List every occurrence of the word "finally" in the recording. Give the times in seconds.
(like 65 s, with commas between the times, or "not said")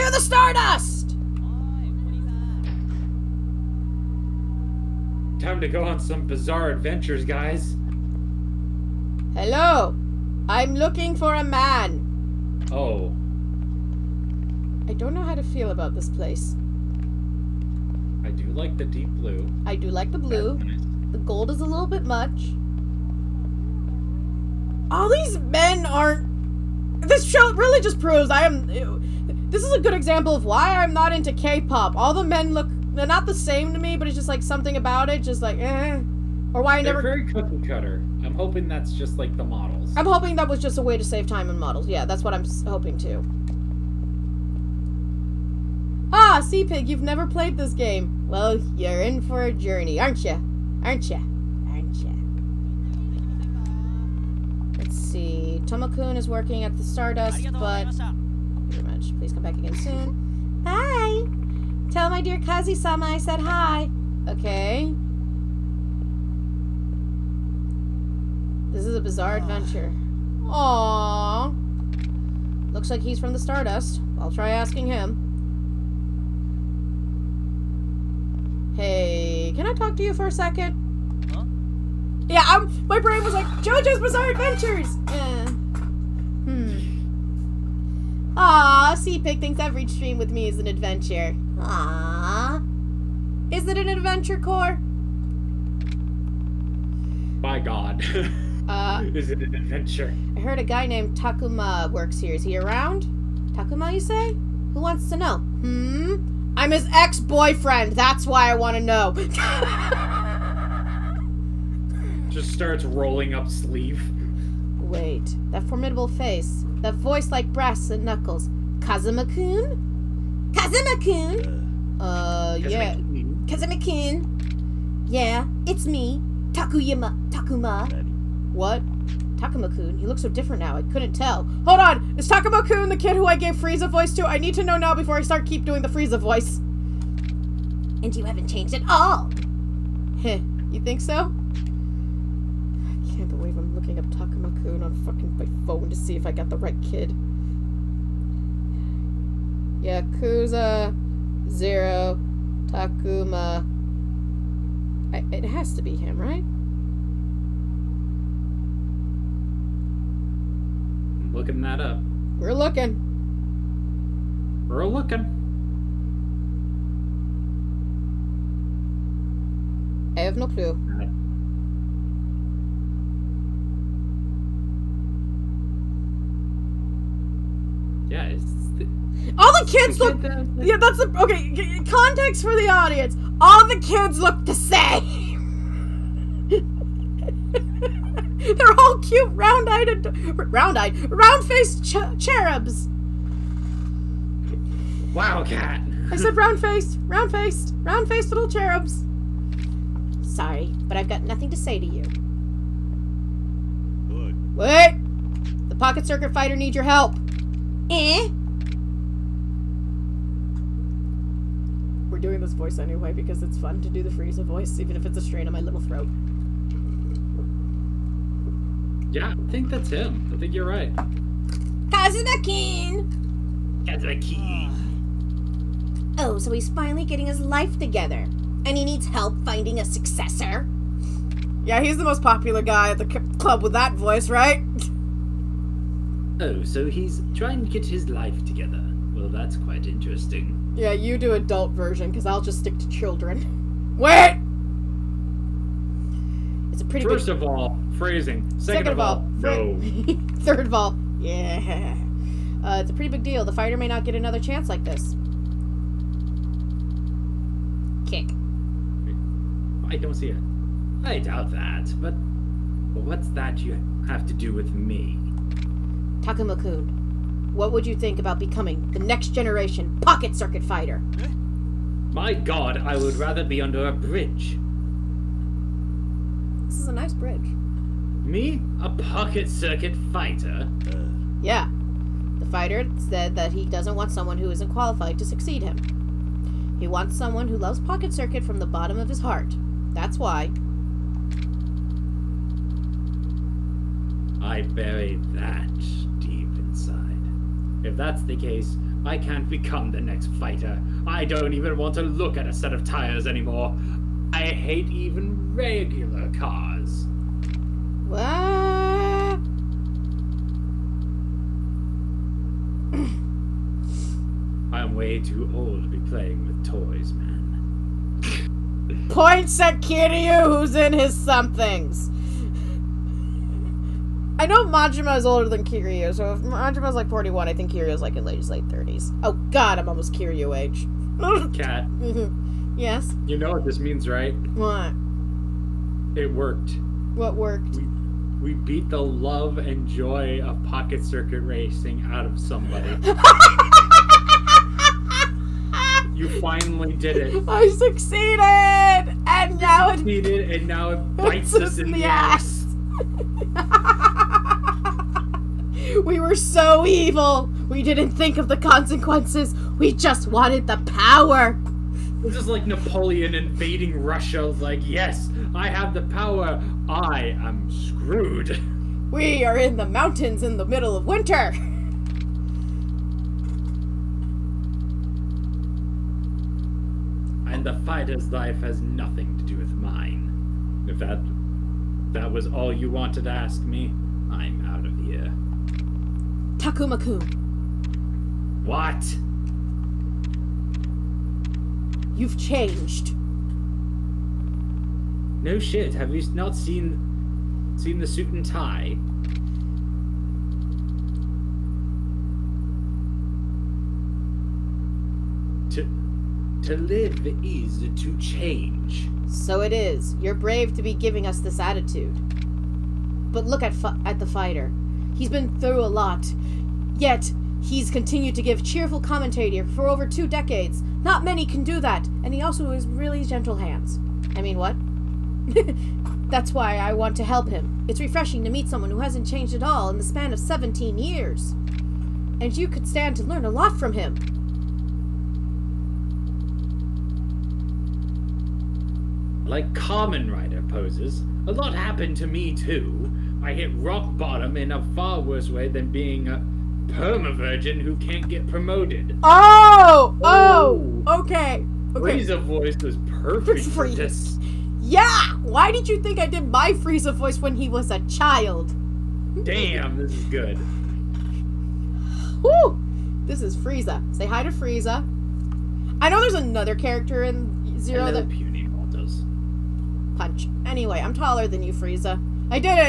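226 s, 346 s.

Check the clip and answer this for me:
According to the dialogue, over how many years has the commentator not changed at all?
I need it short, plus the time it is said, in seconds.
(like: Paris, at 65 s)
17, at 430 s.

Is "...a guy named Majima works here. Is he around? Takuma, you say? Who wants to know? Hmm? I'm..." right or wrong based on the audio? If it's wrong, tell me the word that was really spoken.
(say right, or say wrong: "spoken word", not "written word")
wrong: "Takuma", not "Majima".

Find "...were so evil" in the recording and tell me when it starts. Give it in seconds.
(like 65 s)
356 s.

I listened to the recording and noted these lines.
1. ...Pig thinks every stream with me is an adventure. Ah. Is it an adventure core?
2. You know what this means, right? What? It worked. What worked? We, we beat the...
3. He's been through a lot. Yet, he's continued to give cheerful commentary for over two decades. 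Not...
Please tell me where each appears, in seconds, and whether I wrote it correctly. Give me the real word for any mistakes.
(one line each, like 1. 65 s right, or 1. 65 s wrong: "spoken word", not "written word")
1. 89 s right
2. 333 s right
3. 415 s right.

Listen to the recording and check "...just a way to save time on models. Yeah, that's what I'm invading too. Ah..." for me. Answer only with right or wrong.
wrong.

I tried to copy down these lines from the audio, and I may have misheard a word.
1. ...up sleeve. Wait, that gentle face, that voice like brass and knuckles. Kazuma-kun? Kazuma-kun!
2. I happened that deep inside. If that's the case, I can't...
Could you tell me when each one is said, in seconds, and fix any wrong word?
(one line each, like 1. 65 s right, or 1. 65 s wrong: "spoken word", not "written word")
1. 113 s wrong: "formidable", not "gentle"
2. 294 s wrong: "buried", not "happened".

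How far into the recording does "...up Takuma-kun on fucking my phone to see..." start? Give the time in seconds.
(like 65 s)
143 s.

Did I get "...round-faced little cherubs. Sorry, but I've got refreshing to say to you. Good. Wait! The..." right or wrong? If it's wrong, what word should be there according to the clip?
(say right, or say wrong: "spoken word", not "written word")
wrong: "nothing", not "refreshing".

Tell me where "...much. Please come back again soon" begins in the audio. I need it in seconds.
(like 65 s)
58 s.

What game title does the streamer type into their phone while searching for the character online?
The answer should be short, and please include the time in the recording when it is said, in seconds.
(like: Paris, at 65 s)
Yakuza Zero, at 149 s.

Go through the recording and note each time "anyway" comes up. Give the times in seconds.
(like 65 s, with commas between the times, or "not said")
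212 s, 470 s.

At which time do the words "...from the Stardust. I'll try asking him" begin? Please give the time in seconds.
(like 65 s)
73 s.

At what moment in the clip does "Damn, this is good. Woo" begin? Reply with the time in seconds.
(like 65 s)
459 s.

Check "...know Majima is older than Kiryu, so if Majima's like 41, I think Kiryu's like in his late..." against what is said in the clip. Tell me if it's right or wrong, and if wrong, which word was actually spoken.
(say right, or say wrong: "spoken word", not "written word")
right.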